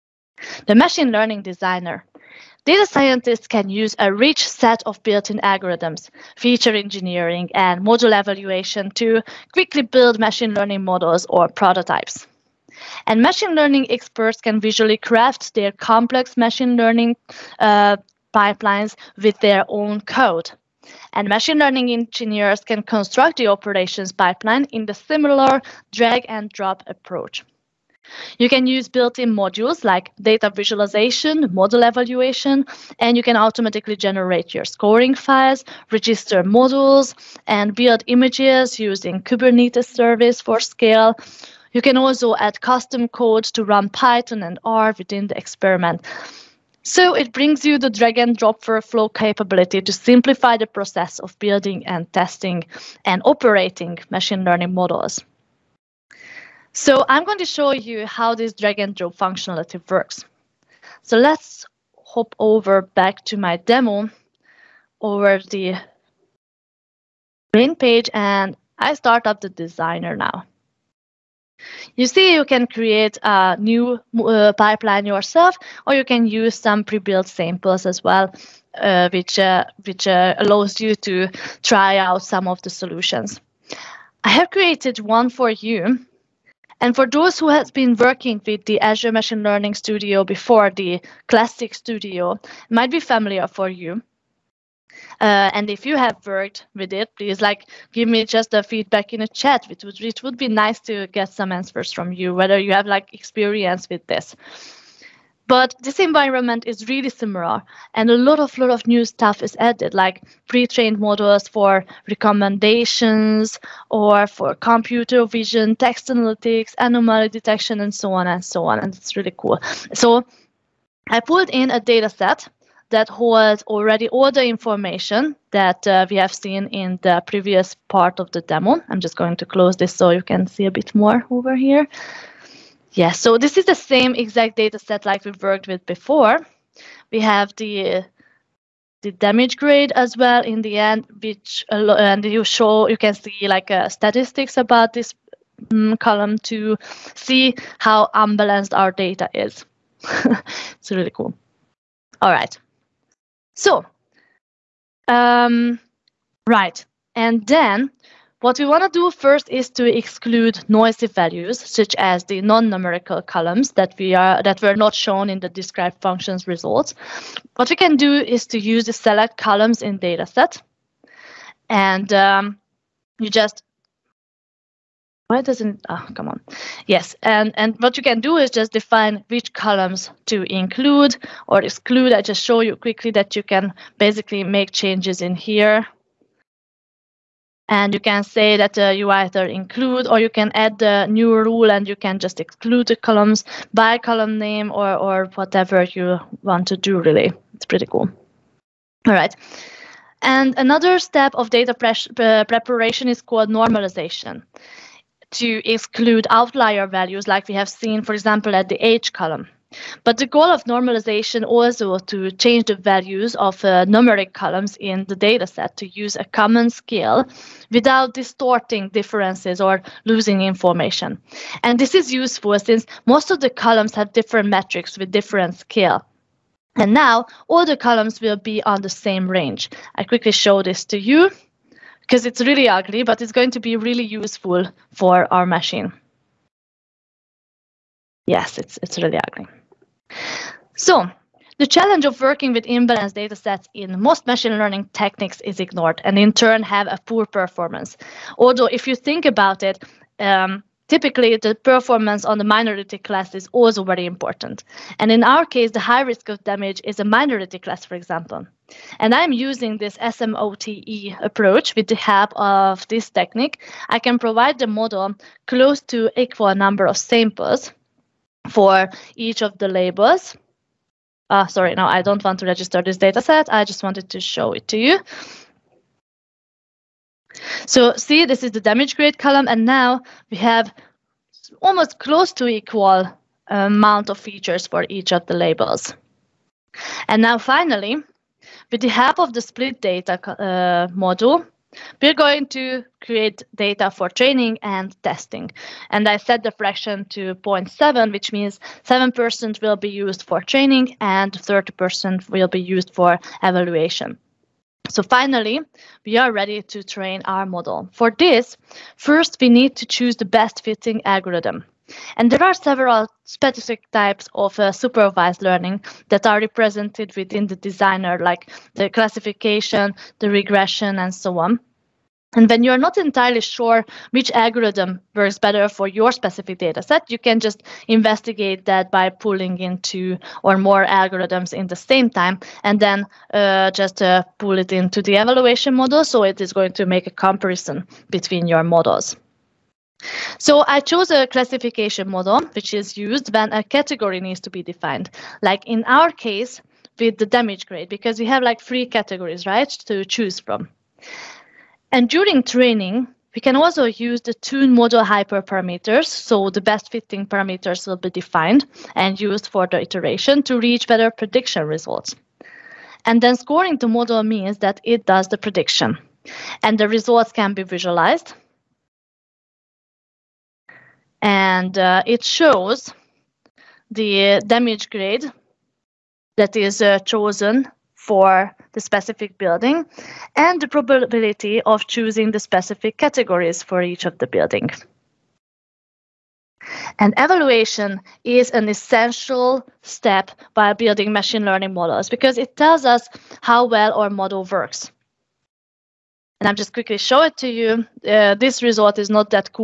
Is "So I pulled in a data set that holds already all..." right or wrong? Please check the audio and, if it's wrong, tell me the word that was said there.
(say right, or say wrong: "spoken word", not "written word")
right.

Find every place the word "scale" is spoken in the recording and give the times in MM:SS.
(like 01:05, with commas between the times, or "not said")
00:40, 03:36, 03:45.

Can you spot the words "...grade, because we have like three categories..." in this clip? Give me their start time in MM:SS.
05:47.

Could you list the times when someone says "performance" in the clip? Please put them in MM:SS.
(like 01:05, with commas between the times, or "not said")
04:07, 04:11.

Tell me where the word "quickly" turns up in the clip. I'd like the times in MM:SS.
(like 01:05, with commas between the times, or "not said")
00:09, 03:02, 03:50, 06:36.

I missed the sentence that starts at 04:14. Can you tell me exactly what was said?
And in our case, the high risk of damage is a minority class, for example.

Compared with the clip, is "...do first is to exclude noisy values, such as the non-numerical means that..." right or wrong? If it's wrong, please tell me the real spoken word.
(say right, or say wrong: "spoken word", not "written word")
wrong: "columns", not "means".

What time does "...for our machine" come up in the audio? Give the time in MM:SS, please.
03:54.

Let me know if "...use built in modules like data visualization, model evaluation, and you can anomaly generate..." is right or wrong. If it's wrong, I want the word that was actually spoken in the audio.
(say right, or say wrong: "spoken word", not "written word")
wrong: "automatically", not "anomaly".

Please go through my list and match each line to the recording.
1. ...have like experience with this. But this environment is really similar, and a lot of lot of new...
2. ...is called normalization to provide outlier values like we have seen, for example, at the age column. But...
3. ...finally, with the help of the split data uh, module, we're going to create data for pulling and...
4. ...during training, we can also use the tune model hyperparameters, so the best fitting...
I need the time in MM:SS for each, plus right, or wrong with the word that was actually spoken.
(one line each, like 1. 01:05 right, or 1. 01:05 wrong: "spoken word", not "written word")
1. 01:42 right
2. 03:23 wrong: "exclude", not "provide"
3. 04:47 wrong: "training", not "pulling"
4. 05:52 right.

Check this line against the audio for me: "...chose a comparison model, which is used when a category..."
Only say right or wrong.
wrong.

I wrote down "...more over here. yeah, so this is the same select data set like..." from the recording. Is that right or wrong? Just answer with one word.
wrong.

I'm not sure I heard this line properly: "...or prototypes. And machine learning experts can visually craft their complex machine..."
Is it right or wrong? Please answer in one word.
right.